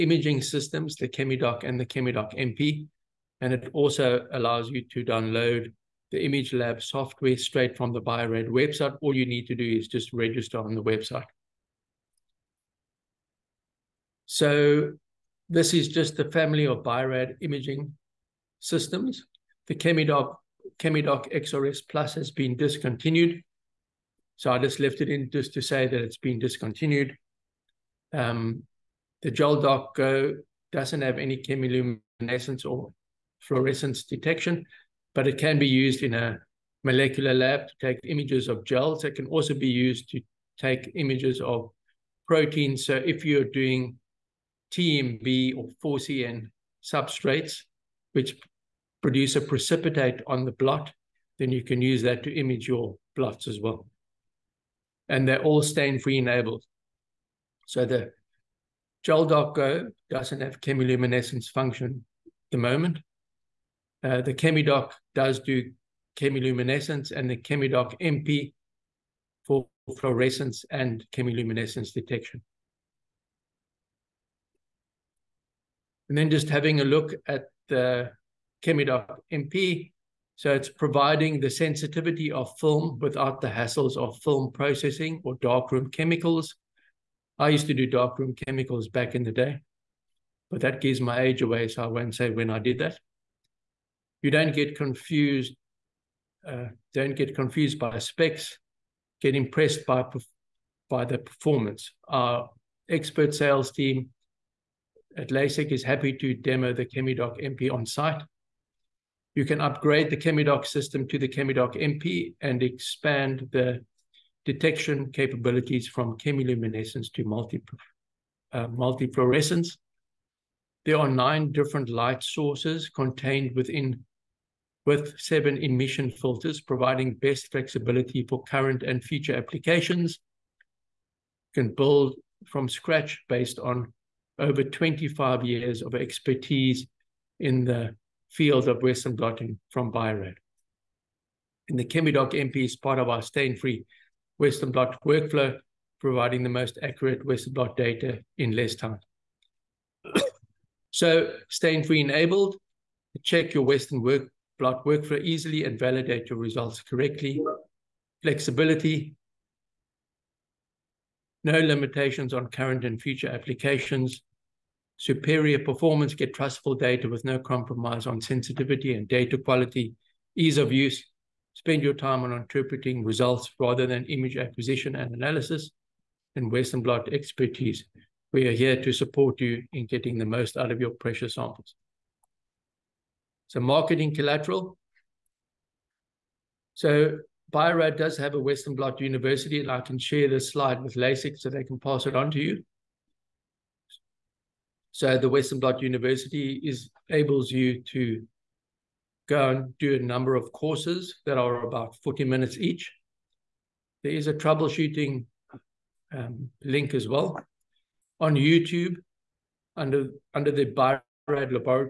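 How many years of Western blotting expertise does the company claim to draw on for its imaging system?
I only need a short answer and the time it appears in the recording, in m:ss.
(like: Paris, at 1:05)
25, at 2:14.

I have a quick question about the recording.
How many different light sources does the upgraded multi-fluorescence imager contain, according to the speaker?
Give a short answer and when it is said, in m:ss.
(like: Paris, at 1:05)
9, at 2:01.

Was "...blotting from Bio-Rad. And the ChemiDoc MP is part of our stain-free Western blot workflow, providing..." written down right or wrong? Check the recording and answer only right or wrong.
right.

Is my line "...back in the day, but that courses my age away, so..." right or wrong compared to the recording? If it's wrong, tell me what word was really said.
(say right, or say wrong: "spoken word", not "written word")
wrong: "gives", not "courses".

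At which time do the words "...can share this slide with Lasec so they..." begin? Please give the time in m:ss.
3:09.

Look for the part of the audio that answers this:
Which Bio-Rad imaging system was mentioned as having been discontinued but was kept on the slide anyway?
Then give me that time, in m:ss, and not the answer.
0:20.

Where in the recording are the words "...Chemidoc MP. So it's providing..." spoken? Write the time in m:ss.
1:18.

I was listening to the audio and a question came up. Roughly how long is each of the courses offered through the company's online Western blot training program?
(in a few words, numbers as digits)
40 minutes.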